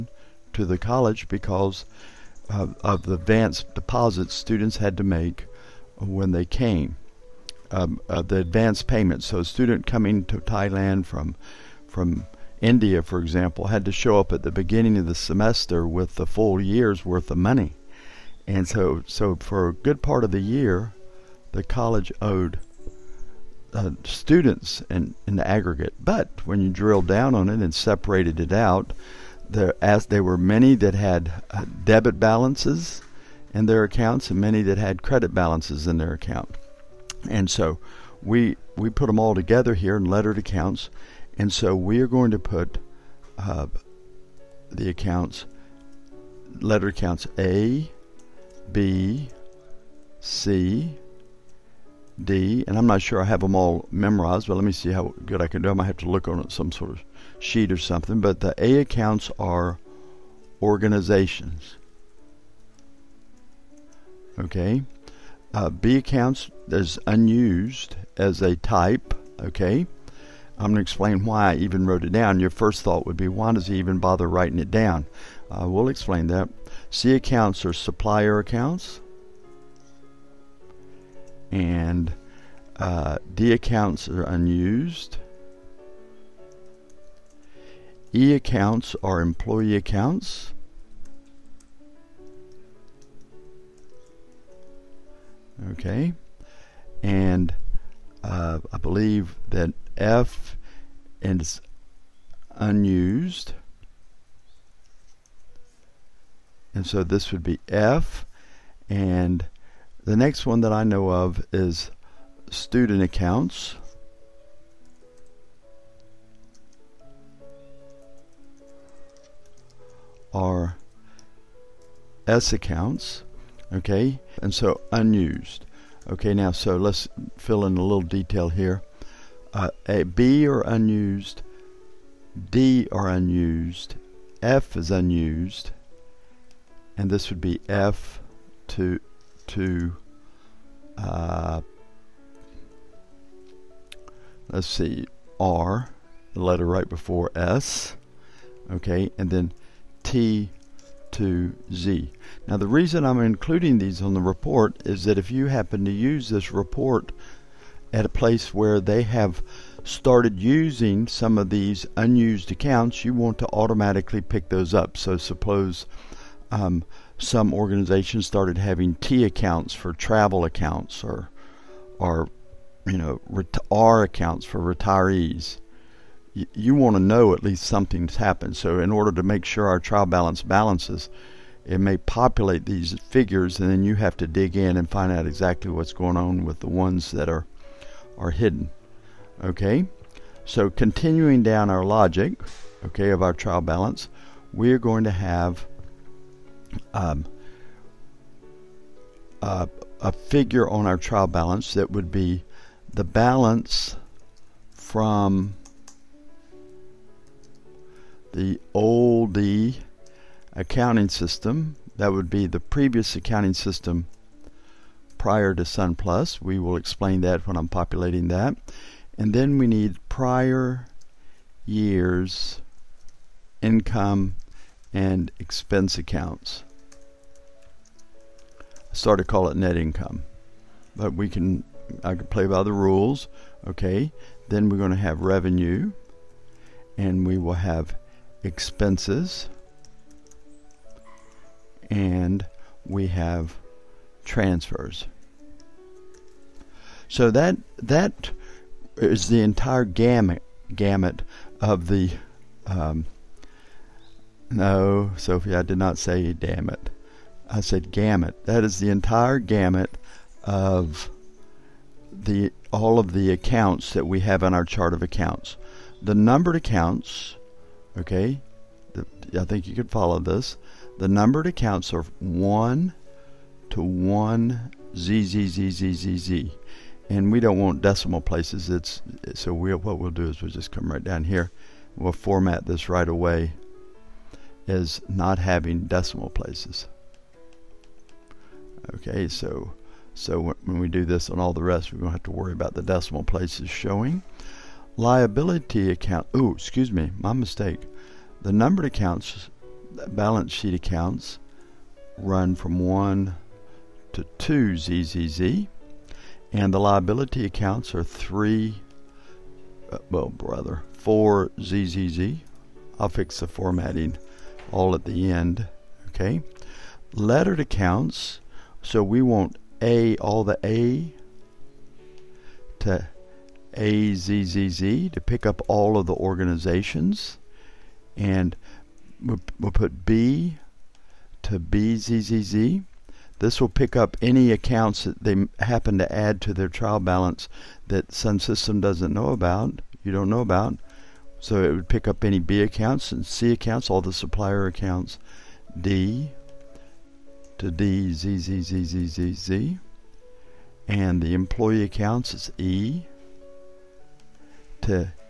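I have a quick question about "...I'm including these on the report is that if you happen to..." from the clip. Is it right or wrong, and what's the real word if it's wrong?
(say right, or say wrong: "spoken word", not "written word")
right.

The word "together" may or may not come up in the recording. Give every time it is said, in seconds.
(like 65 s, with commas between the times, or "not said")
39 s.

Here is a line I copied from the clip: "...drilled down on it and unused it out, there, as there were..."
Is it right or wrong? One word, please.
wrong.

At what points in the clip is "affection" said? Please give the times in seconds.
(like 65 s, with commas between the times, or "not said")
not said.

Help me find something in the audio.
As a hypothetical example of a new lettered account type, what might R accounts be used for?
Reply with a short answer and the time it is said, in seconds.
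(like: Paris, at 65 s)
Retirees, at 174 s.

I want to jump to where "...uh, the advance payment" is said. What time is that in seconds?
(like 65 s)
8 s.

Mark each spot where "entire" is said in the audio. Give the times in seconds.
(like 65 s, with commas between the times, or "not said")
249 s, 258 s.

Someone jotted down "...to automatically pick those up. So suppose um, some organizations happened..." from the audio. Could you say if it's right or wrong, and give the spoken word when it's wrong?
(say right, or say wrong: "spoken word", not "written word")
wrong: "started", not "happened".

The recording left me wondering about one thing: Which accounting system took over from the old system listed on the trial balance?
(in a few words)
SunPlus.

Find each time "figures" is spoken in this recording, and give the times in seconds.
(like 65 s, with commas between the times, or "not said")
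182 s, 200 s.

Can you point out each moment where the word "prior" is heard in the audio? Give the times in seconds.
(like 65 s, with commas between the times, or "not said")
215 s, 220 s.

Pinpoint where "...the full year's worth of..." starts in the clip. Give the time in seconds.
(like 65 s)
16 s.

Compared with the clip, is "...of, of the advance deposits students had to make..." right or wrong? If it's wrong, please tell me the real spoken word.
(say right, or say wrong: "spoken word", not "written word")
right.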